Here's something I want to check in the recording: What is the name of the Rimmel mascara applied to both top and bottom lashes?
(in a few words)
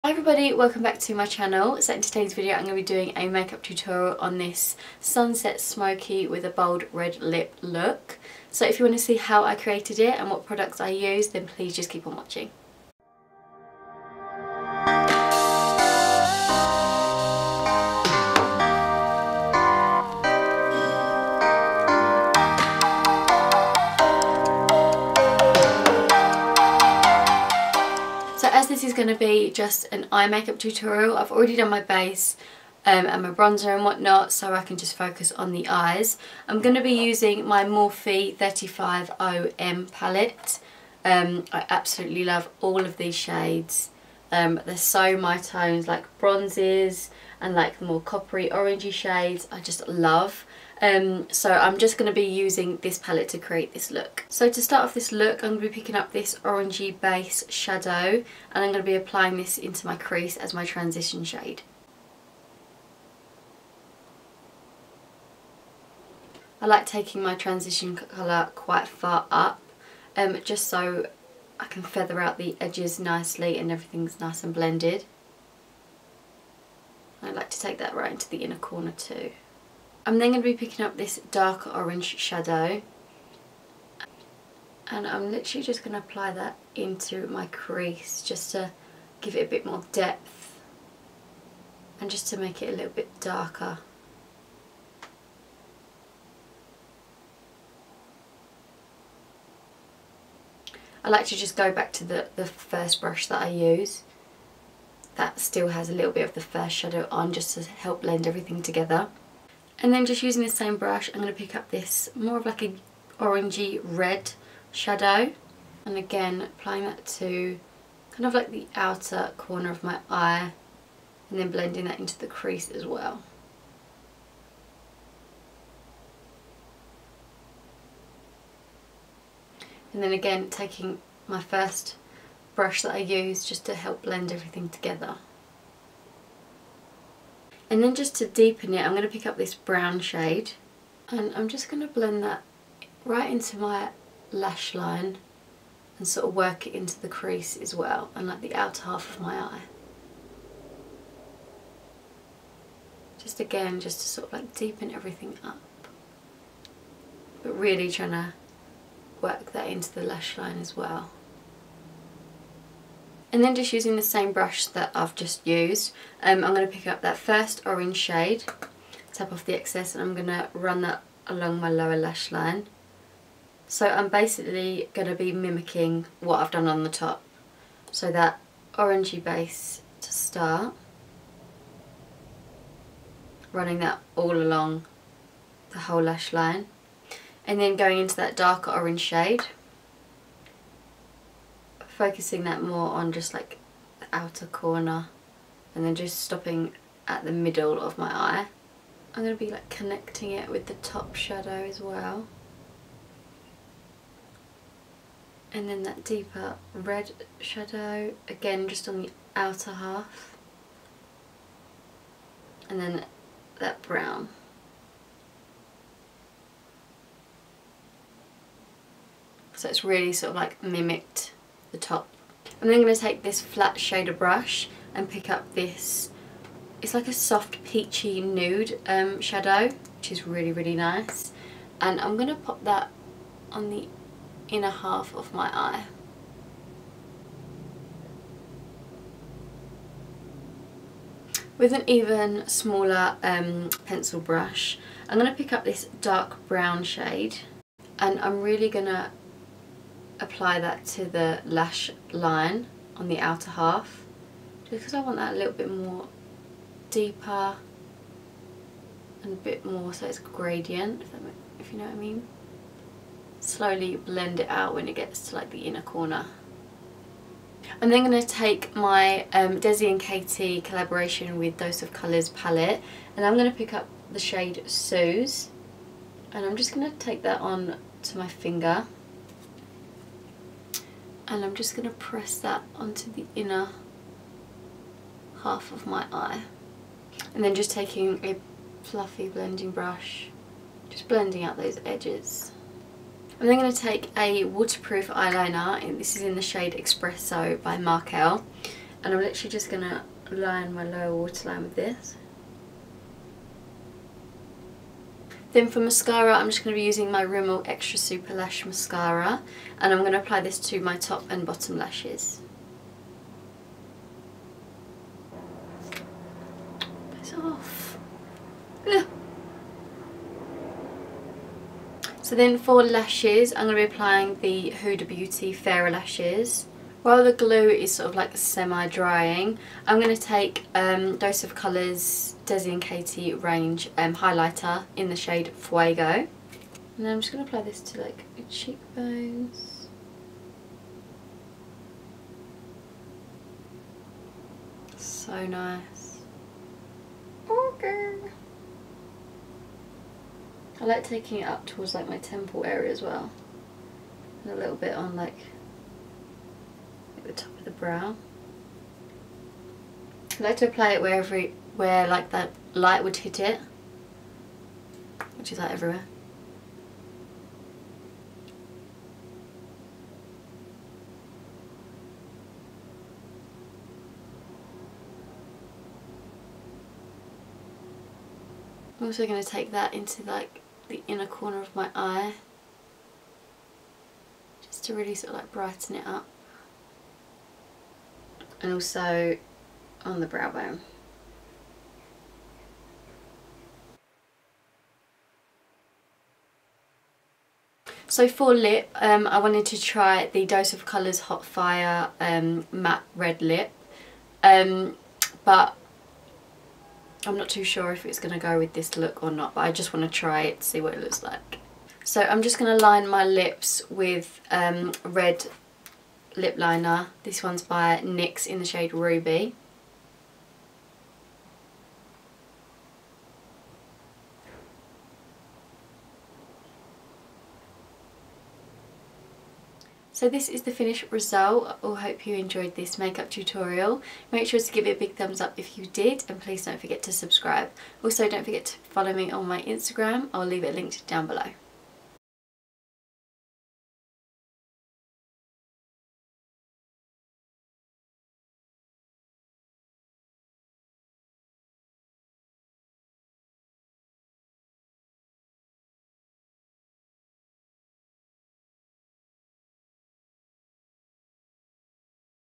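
Extra Super Lash.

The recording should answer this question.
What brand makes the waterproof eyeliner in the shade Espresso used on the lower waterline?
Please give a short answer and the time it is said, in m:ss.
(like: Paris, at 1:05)
Markel, at 4:57.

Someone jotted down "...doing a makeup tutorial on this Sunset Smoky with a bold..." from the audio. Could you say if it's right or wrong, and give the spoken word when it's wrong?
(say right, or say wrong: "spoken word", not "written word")
right.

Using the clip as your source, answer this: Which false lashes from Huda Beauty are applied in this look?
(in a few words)
Farah.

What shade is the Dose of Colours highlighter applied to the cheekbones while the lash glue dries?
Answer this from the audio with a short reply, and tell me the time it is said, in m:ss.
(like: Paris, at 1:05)
Fuego, at 5:35.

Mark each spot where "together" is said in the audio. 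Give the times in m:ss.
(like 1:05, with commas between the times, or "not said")
1:48, 2:14.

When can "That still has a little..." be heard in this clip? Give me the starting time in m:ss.
1:45.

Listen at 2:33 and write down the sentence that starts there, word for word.
Just again, just to sort of like deepen everything up.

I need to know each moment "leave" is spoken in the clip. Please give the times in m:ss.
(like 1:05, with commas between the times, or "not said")
7:20.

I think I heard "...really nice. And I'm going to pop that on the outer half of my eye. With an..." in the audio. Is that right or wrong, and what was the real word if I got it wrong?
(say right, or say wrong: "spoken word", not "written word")
wrong: "inner", not "outer".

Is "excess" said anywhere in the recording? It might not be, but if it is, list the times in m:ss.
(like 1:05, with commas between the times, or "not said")
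2:49.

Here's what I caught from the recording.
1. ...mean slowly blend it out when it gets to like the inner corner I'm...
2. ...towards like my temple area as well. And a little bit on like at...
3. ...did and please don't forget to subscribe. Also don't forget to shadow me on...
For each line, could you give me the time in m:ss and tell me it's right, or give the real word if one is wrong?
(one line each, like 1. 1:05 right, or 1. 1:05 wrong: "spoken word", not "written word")
1. 4:21 right
2. 5:51 right
3. 7:15 wrong: "follow", not "shadow".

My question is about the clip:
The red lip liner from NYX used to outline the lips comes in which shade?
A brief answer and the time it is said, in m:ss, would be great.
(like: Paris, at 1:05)
Ruby, at 6:58.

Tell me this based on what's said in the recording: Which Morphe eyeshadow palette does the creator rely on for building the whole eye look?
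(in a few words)
350M.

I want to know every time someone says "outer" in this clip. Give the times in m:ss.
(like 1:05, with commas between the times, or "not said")
1:58, 2:28, 3:14, 3:29, 4:13.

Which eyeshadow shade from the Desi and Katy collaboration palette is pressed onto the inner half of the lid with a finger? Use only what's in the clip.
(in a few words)
Suz.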